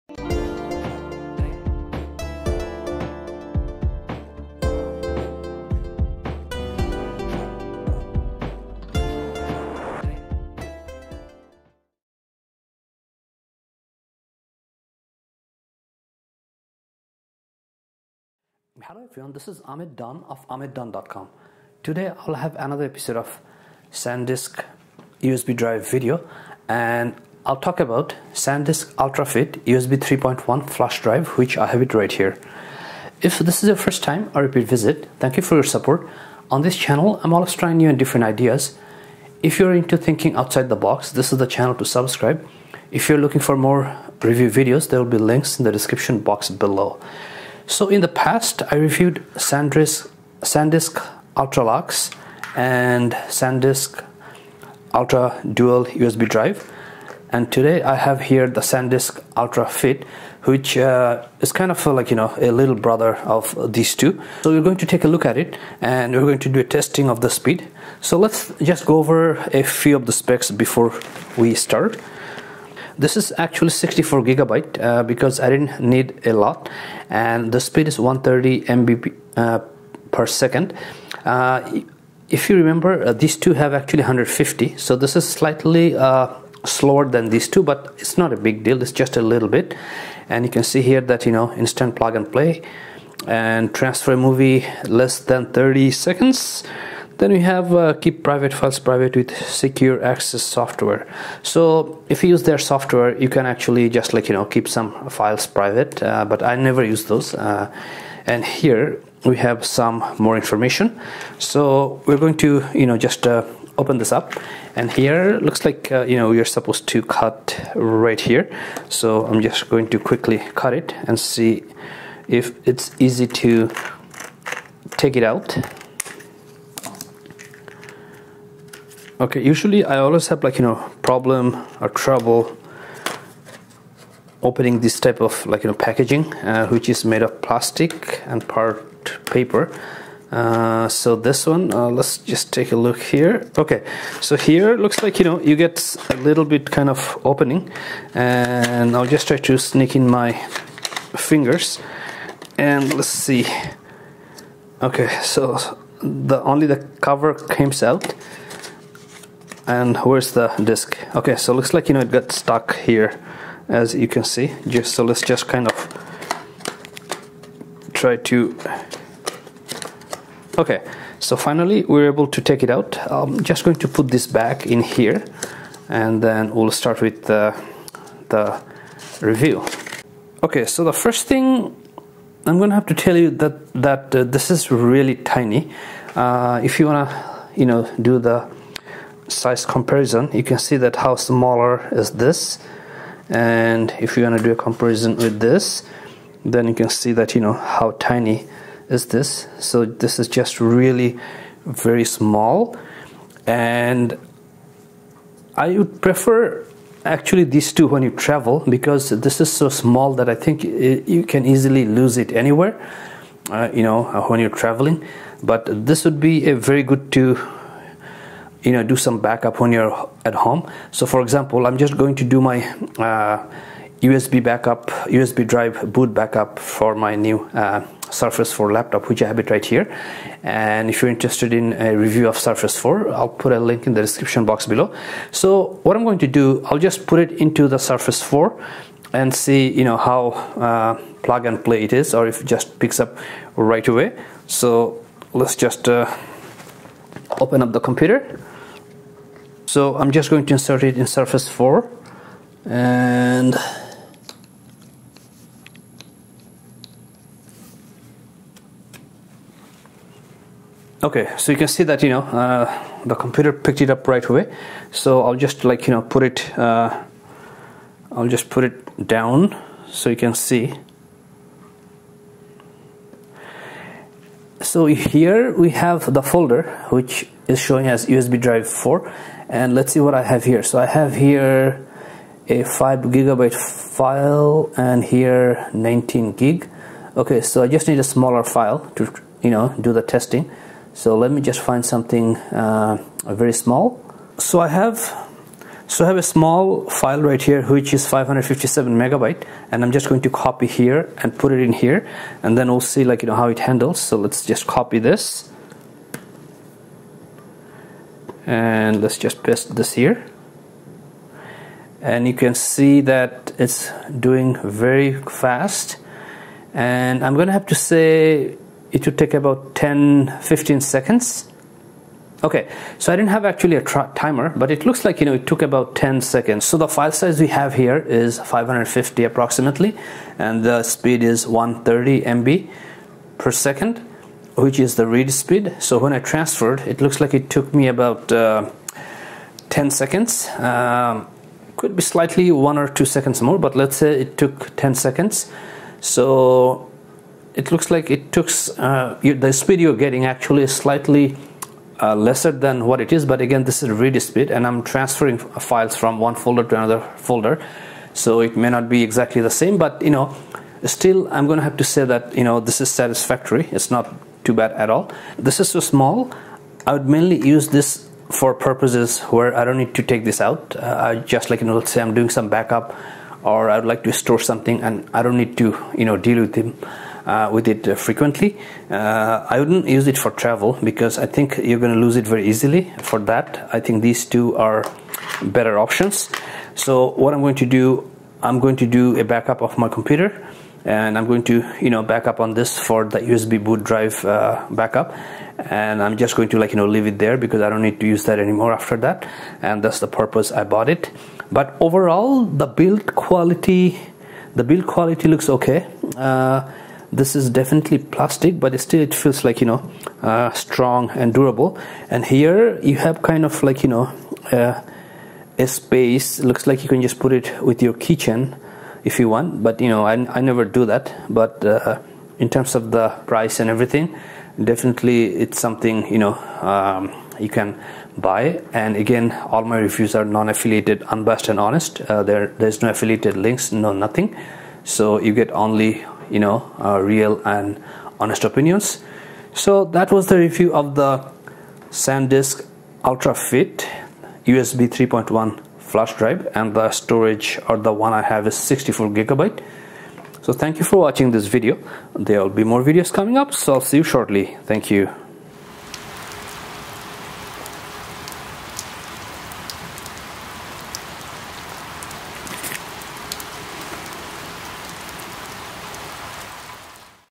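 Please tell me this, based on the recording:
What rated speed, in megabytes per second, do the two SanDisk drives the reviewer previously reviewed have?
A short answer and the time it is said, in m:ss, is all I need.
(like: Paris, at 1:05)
150, at 1:24.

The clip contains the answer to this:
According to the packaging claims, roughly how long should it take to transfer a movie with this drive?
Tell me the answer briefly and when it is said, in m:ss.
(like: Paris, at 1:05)
less than 30 seconds, at 1:34.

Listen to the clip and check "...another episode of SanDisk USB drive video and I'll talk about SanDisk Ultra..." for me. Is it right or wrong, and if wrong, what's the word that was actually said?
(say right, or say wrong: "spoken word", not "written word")
right.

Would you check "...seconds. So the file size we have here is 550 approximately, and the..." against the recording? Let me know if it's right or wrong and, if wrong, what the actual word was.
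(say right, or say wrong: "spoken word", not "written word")
right.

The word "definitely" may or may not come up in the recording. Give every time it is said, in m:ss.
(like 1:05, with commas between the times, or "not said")
6:47, 7:04.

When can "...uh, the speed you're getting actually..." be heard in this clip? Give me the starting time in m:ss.
5:48.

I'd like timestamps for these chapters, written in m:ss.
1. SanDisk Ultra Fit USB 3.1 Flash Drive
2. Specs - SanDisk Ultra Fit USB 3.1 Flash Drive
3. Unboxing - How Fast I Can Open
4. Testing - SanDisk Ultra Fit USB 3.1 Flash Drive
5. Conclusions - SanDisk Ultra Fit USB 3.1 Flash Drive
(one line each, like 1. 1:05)
1. 0:15
2. 1:10
3. 2:00
4. 4:10
5. 6:00.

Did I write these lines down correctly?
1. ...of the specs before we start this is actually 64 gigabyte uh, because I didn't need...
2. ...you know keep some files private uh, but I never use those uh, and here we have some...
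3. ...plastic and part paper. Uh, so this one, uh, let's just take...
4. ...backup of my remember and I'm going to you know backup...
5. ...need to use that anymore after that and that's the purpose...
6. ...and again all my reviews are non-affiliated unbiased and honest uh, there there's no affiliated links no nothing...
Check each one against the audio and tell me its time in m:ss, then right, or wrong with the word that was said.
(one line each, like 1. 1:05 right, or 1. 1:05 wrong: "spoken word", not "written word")
1. 1:09 right
2. 1:44 right
3. 2:17 right
4. 6:29 wrong: "computer", not "remember"
5. 6:37 right
6. 7:08 right.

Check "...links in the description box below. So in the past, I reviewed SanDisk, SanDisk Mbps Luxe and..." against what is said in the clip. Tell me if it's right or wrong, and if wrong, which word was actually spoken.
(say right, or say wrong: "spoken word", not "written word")
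wrong: "Ultra", not "Mbps".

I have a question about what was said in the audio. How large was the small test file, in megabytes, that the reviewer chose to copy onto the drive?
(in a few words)
557 megabytes.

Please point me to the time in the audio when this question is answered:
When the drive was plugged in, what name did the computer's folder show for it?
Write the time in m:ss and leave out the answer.
4:38.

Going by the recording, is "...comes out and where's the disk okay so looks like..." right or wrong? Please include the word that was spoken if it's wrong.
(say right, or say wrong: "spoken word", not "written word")
right.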